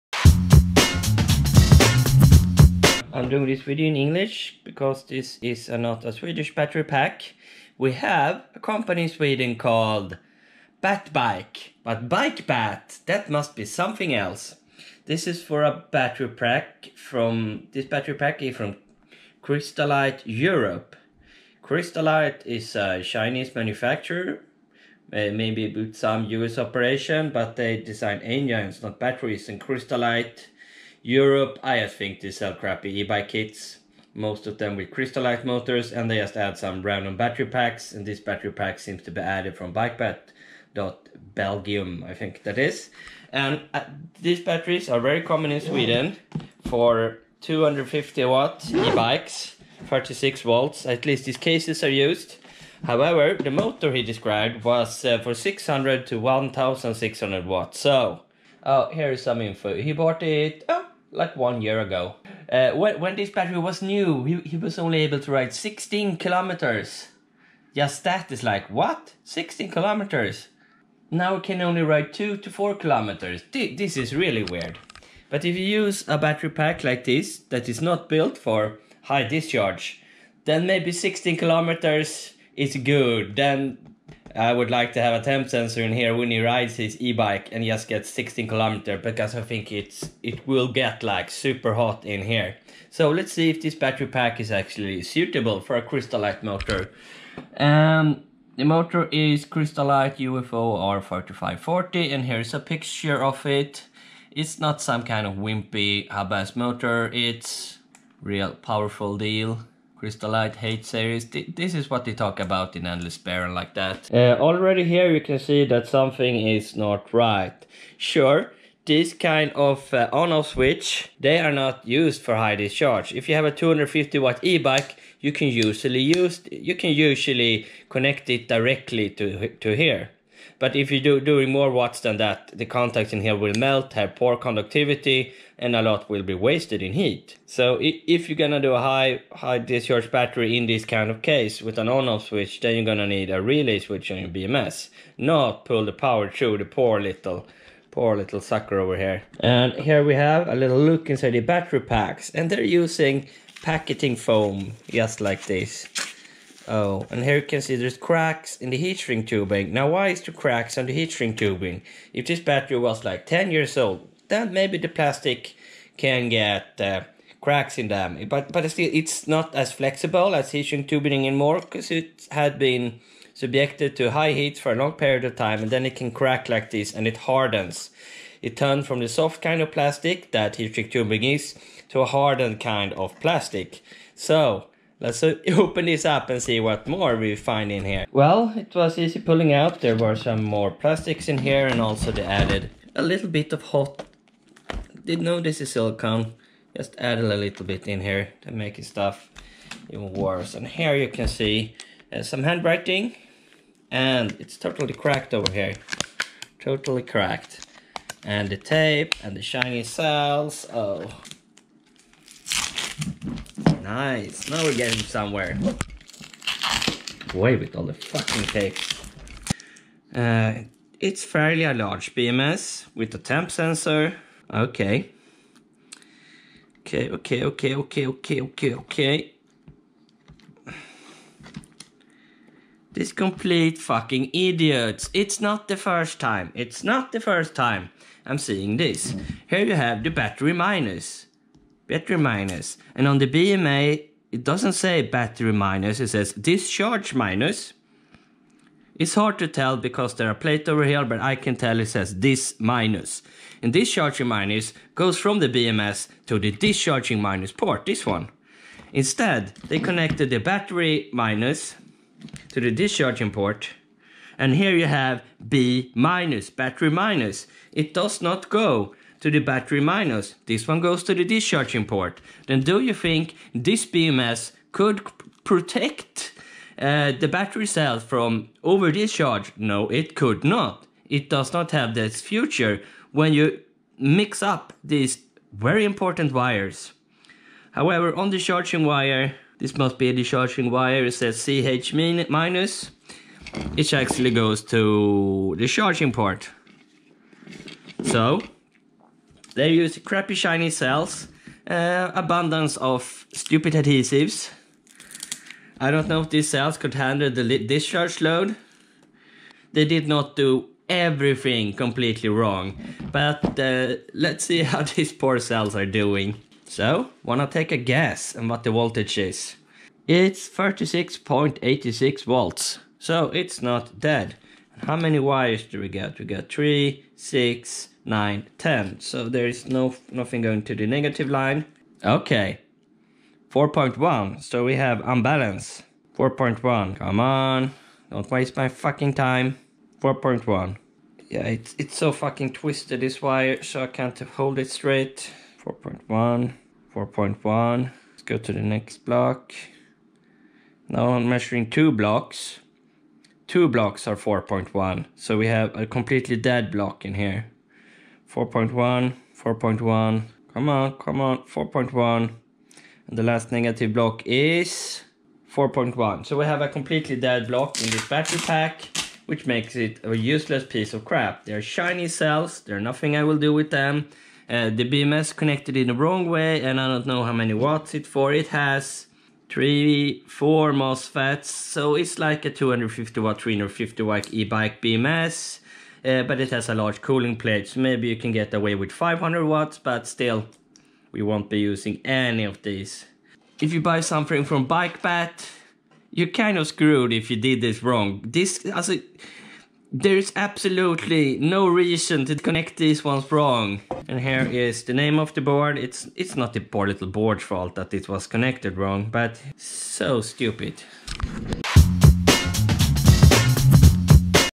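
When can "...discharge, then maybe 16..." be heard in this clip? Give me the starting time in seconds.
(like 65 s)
79 s.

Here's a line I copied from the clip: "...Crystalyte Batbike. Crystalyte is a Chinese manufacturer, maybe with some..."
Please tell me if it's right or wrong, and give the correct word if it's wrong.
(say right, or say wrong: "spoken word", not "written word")
wrong: "Europe", not "Batbike".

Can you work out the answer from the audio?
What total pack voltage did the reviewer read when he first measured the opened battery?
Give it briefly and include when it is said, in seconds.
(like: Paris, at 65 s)
36.86 volts, at 320 s.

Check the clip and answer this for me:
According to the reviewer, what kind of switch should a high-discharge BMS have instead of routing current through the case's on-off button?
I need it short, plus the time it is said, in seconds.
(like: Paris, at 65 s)
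relay switch, at 143 s.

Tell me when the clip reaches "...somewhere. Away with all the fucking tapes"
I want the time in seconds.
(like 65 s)
215 s.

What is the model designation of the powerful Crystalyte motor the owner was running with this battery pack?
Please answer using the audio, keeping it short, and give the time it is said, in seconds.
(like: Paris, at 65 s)
UFO R4540, at 100 s.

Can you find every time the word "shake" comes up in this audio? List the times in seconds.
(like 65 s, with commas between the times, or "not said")
not said.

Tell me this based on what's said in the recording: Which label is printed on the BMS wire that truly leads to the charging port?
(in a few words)
CH minus.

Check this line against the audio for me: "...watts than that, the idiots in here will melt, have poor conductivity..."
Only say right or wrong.
wrong.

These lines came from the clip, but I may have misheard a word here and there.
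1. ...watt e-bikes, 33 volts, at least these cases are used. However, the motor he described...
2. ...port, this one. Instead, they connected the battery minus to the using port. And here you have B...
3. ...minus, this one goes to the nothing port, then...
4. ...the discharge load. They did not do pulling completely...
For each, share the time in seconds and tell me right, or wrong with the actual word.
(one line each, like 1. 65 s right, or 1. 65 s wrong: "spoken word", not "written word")
1. 48 s wrong: "36", not "33"
2. 257 s wrong: "discharging", not "using"
3. 269 s wrong: "discharging", not "nothing"
4. 307 s wrong: "everything", not "pulling".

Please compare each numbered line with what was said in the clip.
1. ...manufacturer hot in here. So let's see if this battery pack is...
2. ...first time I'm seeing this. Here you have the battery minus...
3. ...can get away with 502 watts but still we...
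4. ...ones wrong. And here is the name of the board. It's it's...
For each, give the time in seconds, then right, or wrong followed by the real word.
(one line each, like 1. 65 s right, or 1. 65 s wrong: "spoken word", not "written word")
1. 91 s wrong: "super", not "manufacturer"
2. 237 s right
3. 388 s wrong: "500", not "502"
4. 403 s right.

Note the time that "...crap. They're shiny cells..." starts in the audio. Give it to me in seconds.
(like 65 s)
371 s.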